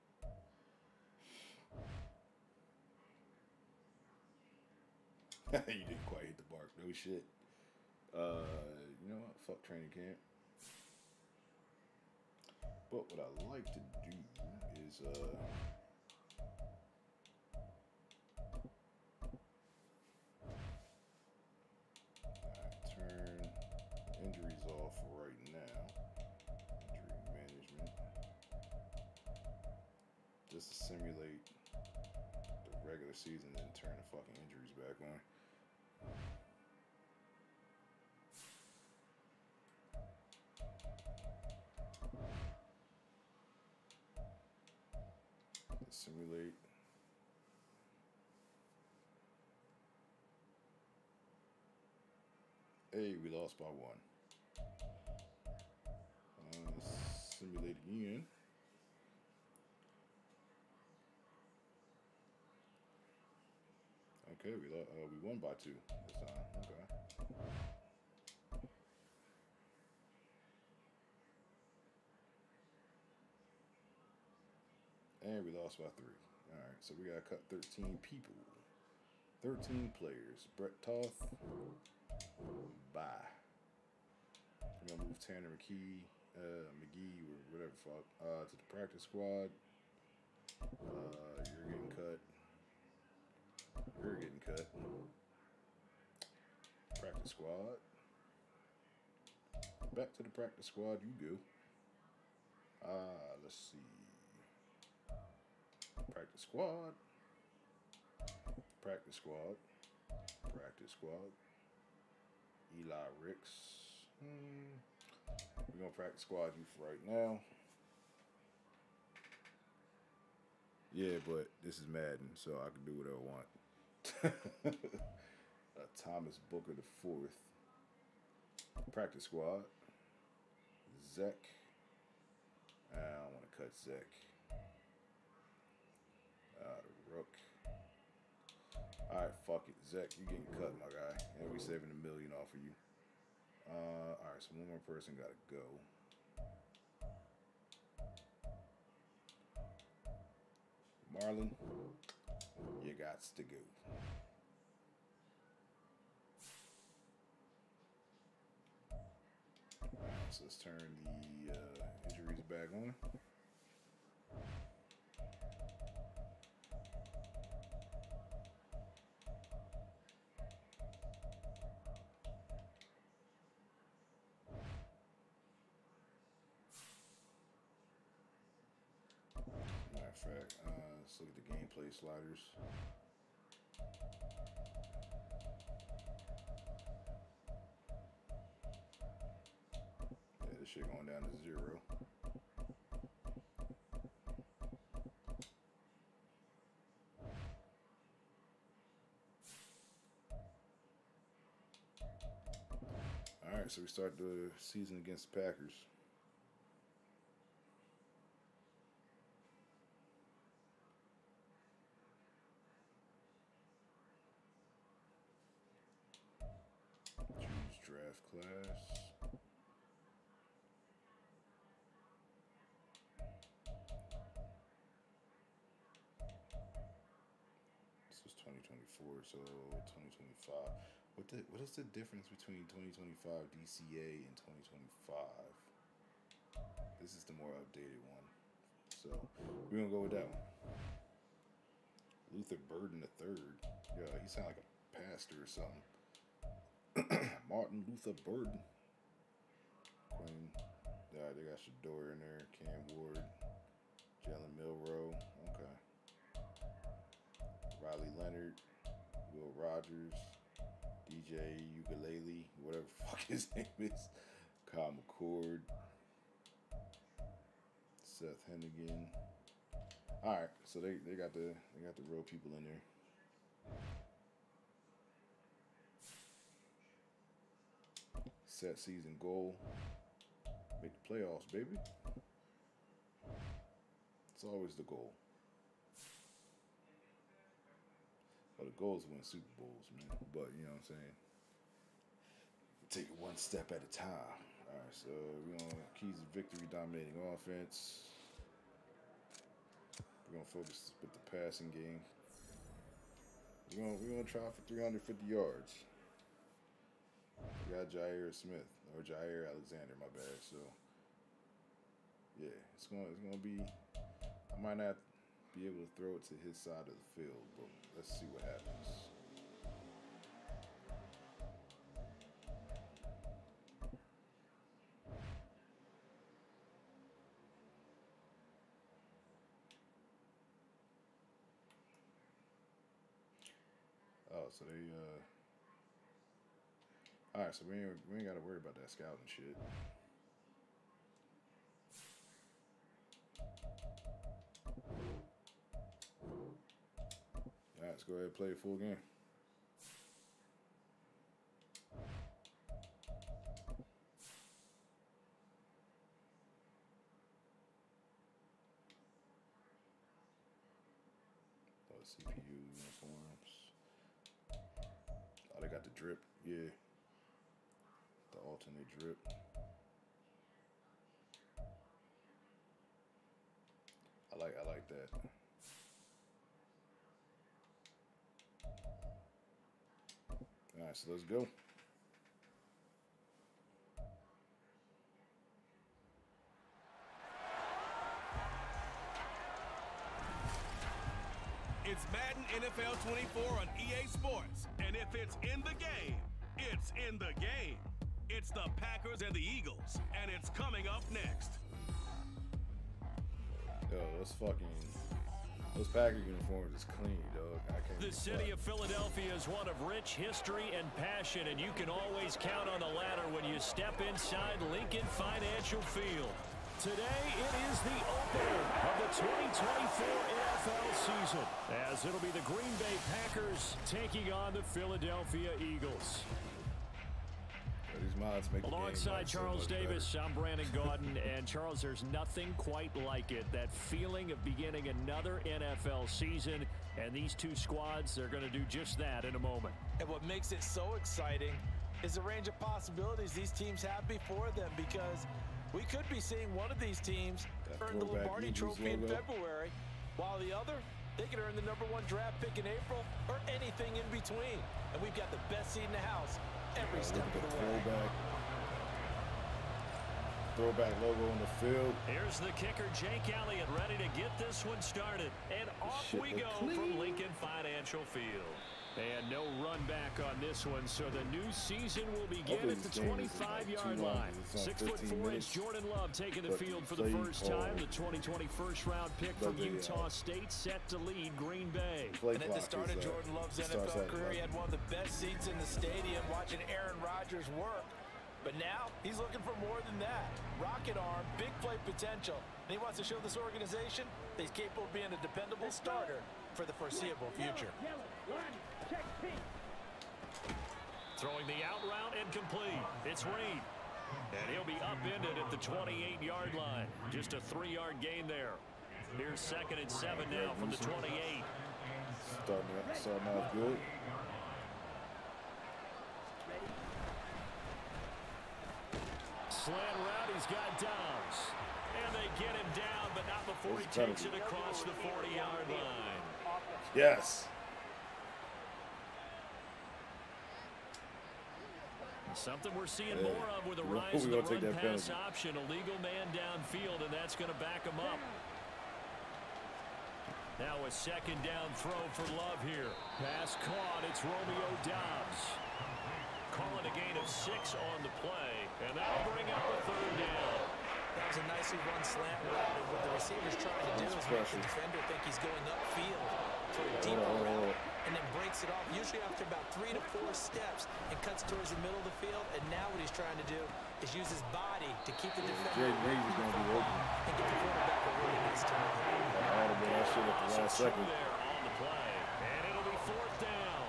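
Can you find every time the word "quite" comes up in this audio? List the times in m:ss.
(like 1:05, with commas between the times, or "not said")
0:06, 7:12.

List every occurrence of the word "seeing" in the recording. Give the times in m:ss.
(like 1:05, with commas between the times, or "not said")
7:26, 8:52.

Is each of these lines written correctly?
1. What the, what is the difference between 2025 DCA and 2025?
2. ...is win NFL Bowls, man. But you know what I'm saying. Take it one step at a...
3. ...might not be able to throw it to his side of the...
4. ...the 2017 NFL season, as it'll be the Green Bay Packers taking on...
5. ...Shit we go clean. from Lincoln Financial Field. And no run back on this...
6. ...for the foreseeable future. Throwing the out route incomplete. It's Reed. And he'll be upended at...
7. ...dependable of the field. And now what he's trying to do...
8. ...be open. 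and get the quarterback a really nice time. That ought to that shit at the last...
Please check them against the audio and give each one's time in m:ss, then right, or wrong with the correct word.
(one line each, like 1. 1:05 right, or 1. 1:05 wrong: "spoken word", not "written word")
1. 3:51 right
2. 4:49 wrong: "Super", not "NFL"
3. 5:14 right
4. 6:58 wrong: "2024", not "2017"
5. 7:46 right
6. 8:16 right
7. 9:21 wrong: "middle", not "dependable"
8. 9:26 right.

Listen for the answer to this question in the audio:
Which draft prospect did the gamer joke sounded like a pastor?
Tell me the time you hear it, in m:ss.
4:02.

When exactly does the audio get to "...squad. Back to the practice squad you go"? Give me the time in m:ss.
1:37.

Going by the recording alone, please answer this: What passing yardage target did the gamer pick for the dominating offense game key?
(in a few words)
350 yards.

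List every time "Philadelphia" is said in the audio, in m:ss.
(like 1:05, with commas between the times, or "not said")
6:48, 7:04.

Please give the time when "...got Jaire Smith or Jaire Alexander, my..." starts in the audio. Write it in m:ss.
5:07.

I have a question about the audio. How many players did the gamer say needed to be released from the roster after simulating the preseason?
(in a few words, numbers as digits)
13.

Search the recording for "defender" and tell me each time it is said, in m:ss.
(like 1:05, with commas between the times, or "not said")
9:14, 9:25.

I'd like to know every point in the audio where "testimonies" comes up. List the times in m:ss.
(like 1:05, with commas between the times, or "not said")
not said.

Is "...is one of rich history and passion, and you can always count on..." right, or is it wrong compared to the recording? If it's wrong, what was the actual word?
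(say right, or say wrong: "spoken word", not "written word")
right.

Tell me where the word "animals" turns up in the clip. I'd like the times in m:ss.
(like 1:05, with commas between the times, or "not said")
not said.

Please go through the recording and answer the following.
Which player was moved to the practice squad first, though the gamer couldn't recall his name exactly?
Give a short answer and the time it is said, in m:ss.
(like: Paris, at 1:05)
Tanner McKee, at 1:25.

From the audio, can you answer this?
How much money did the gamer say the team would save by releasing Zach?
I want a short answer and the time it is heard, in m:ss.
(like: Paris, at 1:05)
a million, at 2:21.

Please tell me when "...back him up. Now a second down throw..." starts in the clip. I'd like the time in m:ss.
8:57.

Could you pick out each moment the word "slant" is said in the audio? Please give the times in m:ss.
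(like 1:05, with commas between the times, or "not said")
8:39, 9:12.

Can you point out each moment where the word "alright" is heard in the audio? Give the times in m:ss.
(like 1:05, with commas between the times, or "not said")
2:19, 2:24, 3:23, 6:20.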